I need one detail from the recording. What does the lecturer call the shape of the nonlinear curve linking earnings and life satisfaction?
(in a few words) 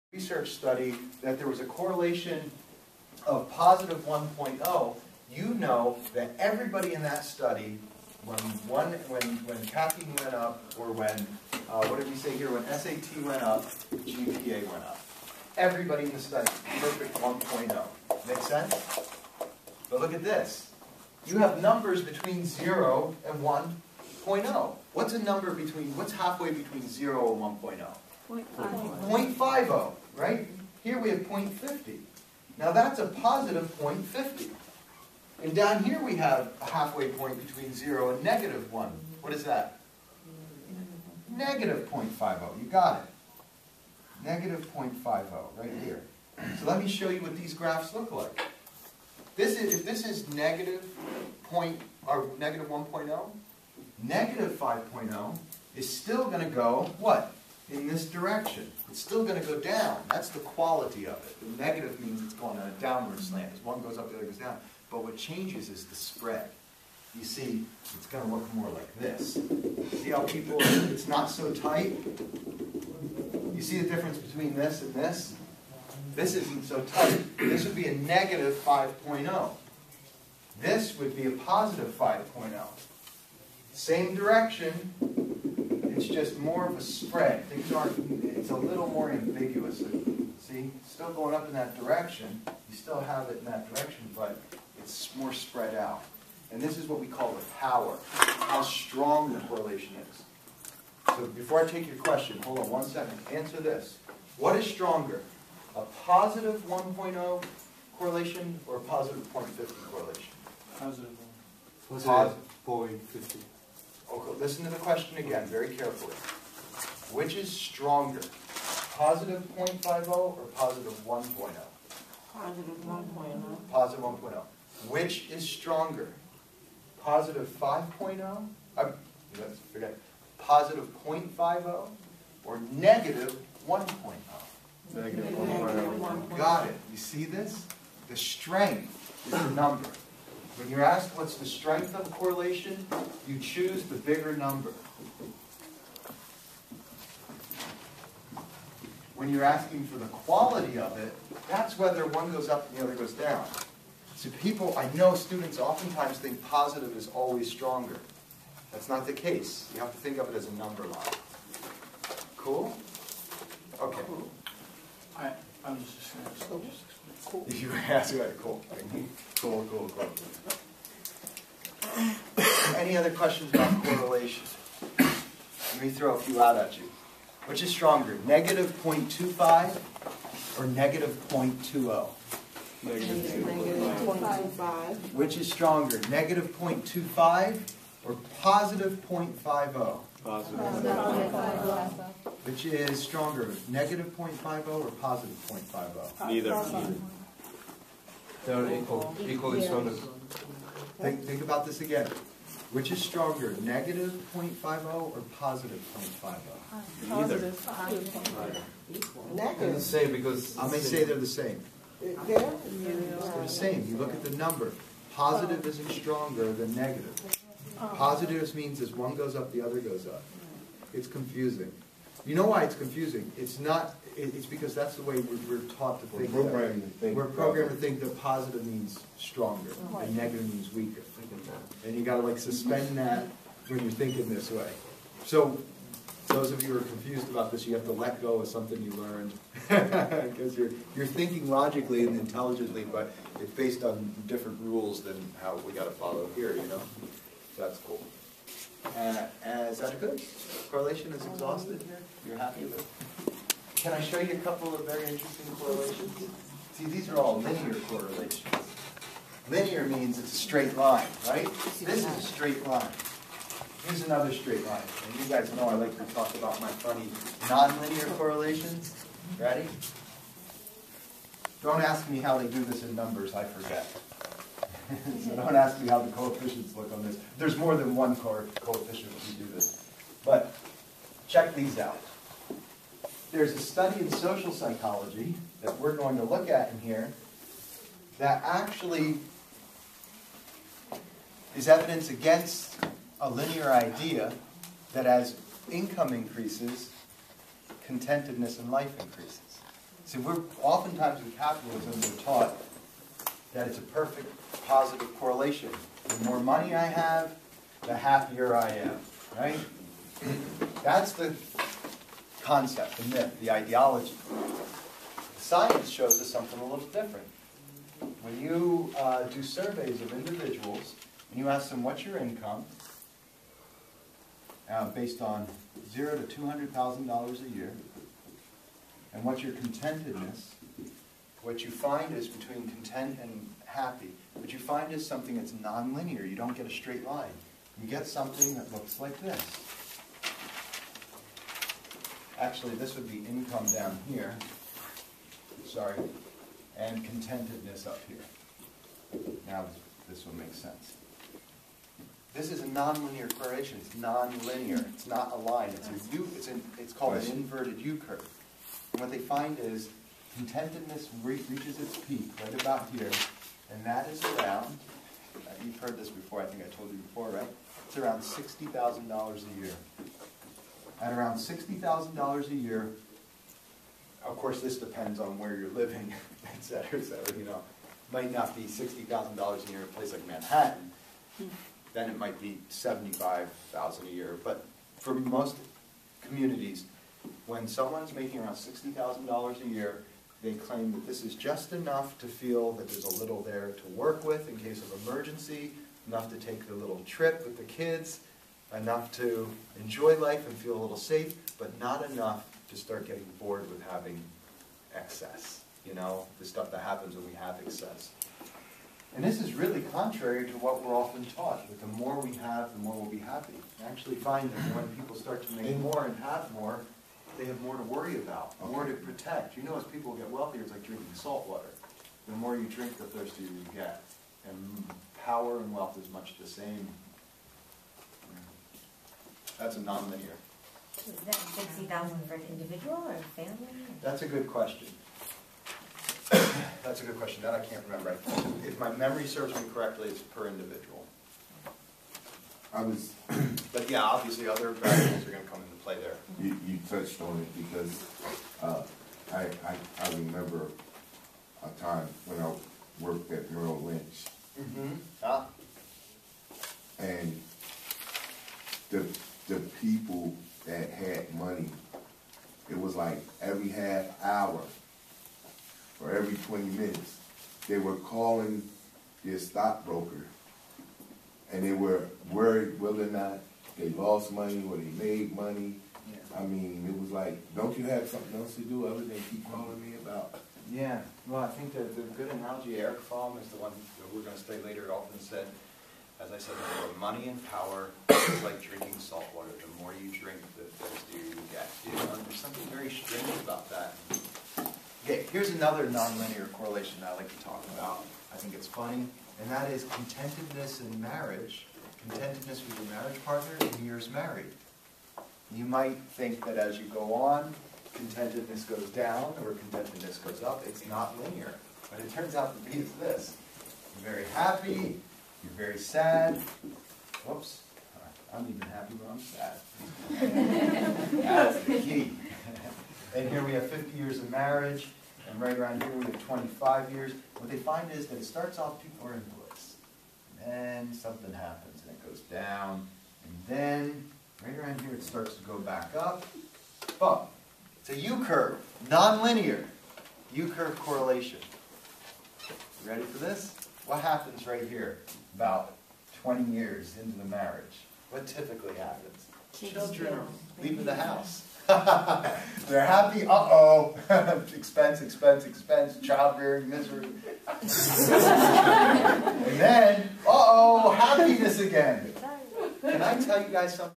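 inverted U curve.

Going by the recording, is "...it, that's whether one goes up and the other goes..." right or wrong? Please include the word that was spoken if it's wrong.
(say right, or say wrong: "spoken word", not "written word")
right.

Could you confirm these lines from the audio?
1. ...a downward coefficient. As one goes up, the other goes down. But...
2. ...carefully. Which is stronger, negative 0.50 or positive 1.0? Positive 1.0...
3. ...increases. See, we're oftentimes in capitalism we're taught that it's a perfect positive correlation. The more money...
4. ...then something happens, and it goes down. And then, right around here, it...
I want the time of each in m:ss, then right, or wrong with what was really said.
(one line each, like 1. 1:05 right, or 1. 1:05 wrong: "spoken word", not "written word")
1. 1:02 wrong: "slant", not "coefficient"
2. 1:55 wrong: "positive", not "negative"
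3. 4:58 right
4. 8:50 right.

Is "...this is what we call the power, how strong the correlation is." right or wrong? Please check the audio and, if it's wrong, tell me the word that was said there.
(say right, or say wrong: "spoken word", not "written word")
right.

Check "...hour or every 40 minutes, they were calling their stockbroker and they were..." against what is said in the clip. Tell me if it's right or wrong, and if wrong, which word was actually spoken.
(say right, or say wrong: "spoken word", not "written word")
wrong: "20", not "40".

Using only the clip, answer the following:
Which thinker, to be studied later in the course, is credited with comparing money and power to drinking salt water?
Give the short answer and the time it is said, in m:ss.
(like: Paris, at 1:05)
Erich Fromm, at 8:02.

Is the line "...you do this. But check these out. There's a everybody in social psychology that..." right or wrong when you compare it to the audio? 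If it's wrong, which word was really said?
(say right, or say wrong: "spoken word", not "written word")
wrong: "study", not "everybody".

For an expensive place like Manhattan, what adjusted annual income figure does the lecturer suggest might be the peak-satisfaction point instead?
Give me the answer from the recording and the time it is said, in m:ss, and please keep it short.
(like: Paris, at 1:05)
$75,000, at 6:22.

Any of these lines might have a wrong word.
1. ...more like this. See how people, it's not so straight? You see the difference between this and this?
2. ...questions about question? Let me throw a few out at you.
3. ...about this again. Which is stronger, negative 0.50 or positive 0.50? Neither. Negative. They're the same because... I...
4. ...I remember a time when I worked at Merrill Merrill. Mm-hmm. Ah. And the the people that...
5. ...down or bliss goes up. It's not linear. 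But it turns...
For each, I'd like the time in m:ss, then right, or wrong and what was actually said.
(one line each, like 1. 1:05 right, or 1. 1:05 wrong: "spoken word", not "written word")
1. 1:08 wrong: "tight", not "straight"
2. 2:53 wrong: "correlation", not "question"
3. 3:21 right
4. 7:30 wrong: "Lynch", not "Merrill"
5. 8:28 wrong: "contentedness", not "bliss".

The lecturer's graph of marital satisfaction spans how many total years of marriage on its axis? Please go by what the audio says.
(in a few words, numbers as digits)
50.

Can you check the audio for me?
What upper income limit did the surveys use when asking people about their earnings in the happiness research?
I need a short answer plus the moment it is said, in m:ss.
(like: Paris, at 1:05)
$200,000, at 5:26.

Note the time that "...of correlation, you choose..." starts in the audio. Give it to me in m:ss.
2:21.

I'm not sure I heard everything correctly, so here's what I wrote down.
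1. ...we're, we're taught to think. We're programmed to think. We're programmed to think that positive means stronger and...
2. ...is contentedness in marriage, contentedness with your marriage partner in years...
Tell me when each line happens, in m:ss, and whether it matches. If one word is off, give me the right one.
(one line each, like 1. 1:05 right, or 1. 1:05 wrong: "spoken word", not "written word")
1. 3:45 right
2. 8:19 right.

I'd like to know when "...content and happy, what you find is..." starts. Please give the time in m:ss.
5:32.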